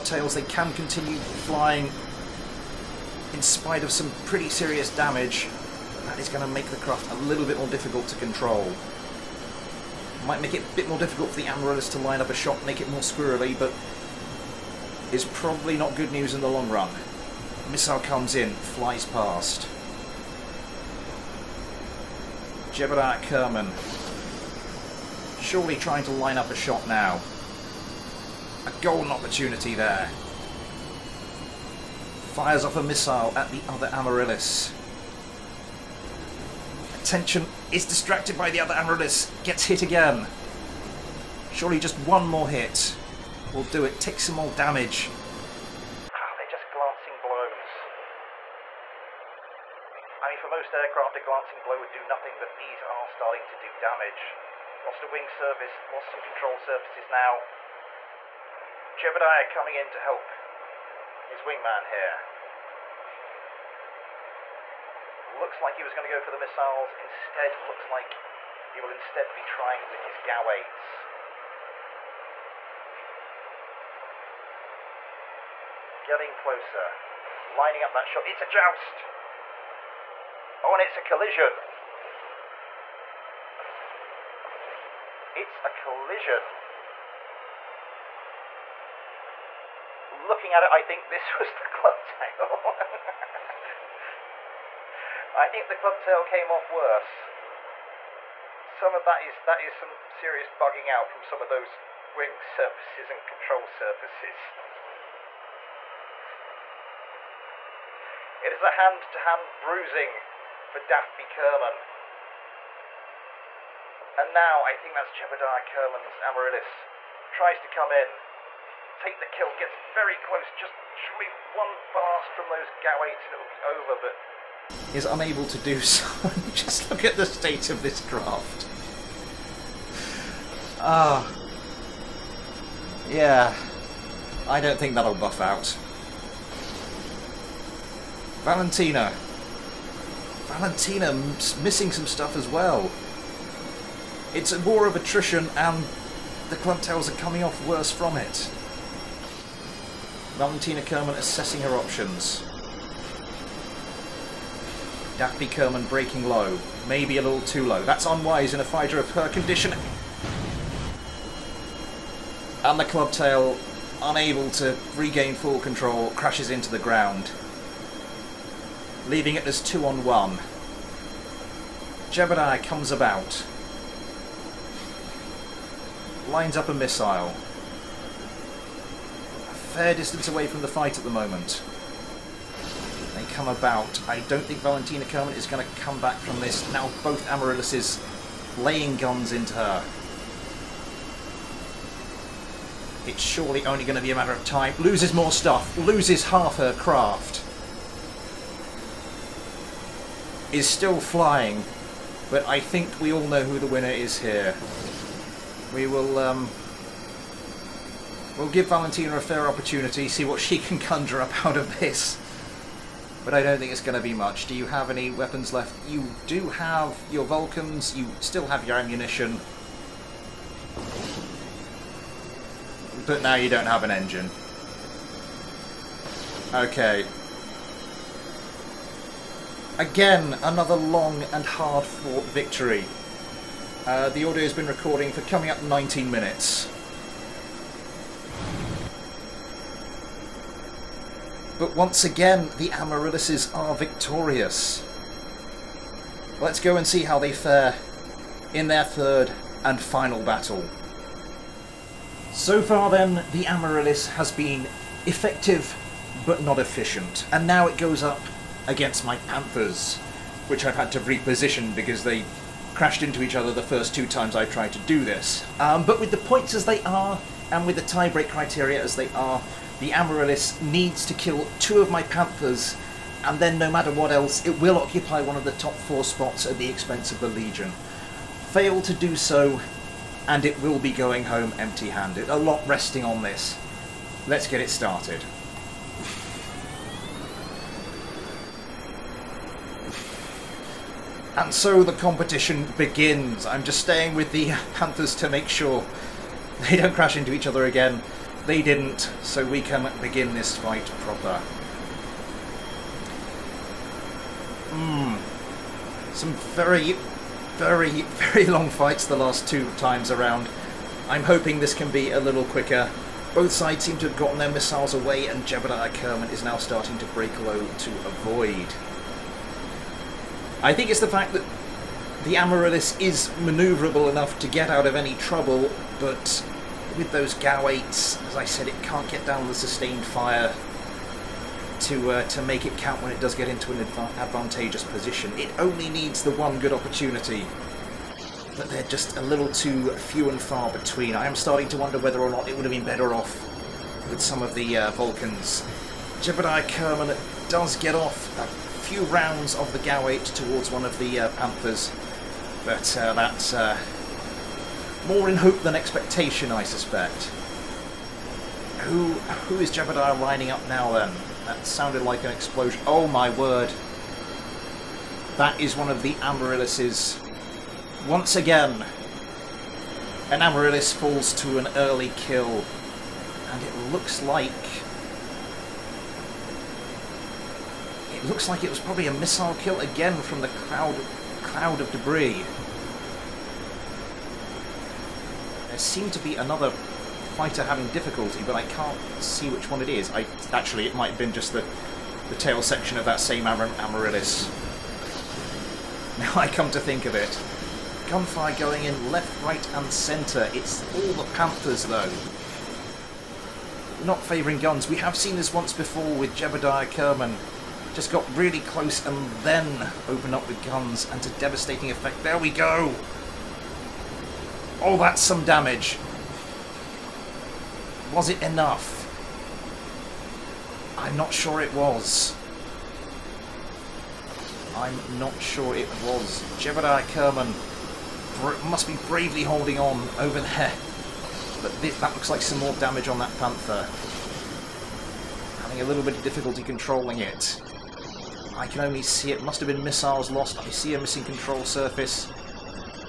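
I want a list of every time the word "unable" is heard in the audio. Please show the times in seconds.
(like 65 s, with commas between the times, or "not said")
125 s, 164 s.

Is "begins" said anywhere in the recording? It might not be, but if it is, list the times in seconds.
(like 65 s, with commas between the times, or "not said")
292 s, 300 s.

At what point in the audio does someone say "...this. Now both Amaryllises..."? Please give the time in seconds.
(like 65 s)
186 s.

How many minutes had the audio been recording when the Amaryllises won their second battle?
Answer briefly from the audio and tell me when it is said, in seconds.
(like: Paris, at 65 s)
19, at 235 s.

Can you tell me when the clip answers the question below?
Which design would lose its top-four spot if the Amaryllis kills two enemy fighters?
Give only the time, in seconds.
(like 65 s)
277 s.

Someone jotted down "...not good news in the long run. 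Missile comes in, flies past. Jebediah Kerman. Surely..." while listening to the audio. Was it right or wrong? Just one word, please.
right.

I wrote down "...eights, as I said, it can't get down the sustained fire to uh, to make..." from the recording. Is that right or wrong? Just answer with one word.
right.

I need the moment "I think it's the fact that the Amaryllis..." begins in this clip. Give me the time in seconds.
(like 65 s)
320 s.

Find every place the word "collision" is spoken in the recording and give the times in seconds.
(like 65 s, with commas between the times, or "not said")
81 s, 85 s.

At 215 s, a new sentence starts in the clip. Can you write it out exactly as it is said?
You do have your Vulcans, you still have your ammunition.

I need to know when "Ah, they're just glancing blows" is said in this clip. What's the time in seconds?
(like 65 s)
46 s.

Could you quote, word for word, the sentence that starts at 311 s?
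I'm hoping this can be a little quicker.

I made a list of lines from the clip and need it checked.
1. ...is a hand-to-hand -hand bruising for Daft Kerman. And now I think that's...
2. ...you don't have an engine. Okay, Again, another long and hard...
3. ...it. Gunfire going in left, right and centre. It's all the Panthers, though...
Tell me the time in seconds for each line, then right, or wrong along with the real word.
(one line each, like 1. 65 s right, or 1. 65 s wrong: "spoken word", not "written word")
1. 108 s right
2. 223 s right
3. 397 s right.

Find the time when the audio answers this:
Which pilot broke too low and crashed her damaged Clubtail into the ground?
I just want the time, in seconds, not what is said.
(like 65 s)
155 s.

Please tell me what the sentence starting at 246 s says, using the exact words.
Let's go and see how they fare in their third and final battle.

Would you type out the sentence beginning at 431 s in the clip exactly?
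But that looks like some more damage on that Panther.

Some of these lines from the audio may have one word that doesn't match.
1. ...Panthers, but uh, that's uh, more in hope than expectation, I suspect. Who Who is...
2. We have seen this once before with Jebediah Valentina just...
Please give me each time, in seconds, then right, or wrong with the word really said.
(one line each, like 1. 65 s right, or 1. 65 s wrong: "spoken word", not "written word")
1. 351 s right
2. 404 s wrong: "Kerman", not "Valentina".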